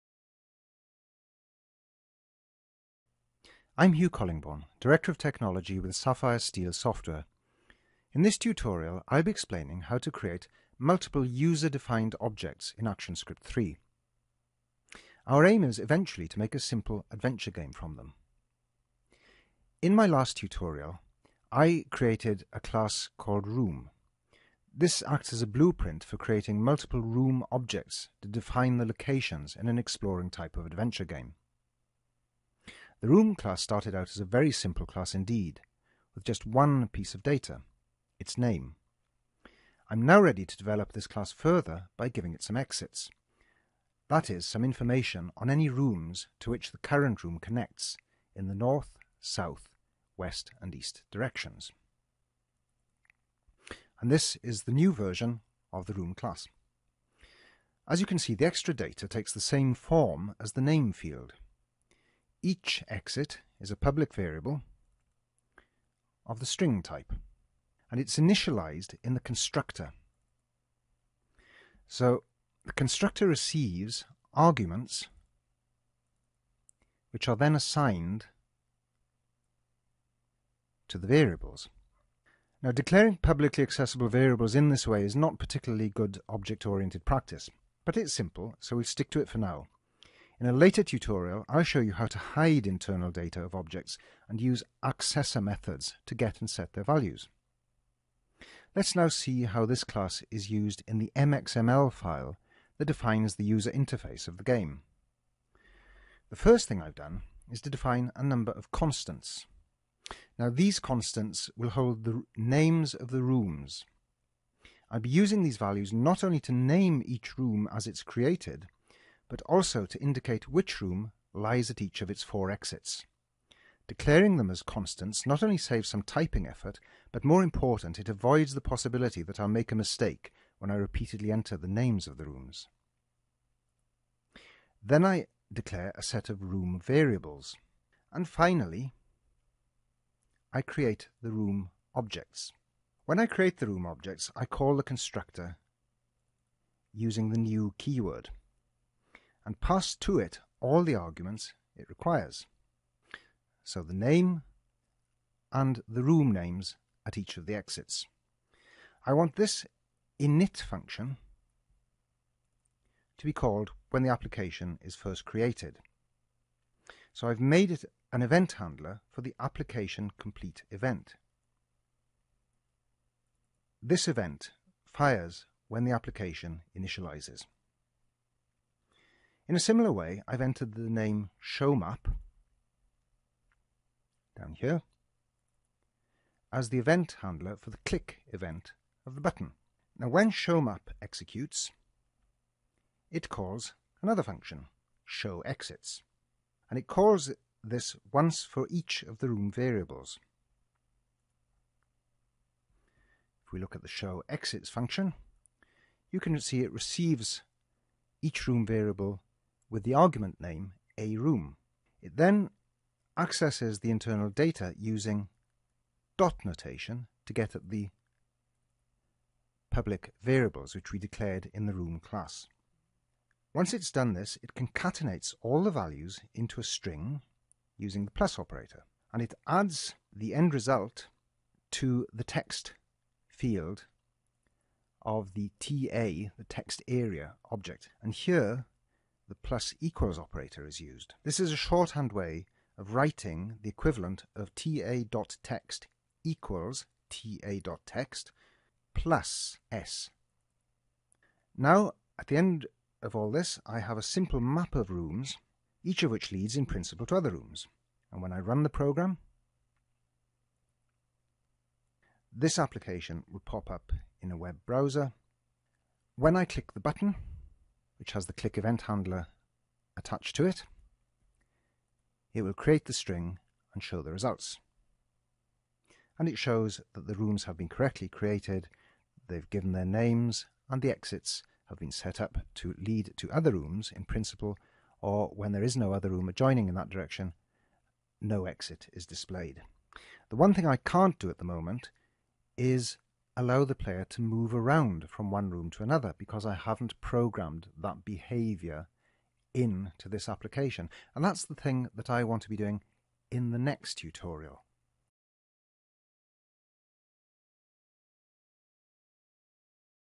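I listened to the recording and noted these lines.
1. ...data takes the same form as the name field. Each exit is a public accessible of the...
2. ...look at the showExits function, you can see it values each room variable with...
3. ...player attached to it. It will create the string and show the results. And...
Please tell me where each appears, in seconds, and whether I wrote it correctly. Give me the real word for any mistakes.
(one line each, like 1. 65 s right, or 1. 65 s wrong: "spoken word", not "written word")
1. 58 s wrong: "variable", not "accessible"
2. 203 s wrong: "receives", not "values"
3. 268 s wrong: "handler", not "player".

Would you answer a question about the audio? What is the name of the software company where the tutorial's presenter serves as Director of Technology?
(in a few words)
SapphireSteel Software.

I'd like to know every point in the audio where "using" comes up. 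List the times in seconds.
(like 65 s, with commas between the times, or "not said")
115 s, 146 s, 214 s, 227 s.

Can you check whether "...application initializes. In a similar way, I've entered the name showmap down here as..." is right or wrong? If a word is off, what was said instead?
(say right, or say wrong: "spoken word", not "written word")
right.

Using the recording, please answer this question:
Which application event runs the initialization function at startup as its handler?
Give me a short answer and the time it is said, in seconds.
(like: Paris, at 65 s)
application complete, at 169 s.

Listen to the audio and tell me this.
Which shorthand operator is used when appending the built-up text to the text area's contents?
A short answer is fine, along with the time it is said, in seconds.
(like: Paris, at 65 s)
plus equals, at 239 s.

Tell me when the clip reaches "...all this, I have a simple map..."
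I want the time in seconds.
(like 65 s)
253 s.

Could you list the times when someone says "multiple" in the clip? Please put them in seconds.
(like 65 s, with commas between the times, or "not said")
10 s, 26 s.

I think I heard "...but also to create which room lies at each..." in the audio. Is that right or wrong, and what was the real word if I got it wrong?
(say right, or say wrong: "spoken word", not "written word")
wrong: "indicate", not "create".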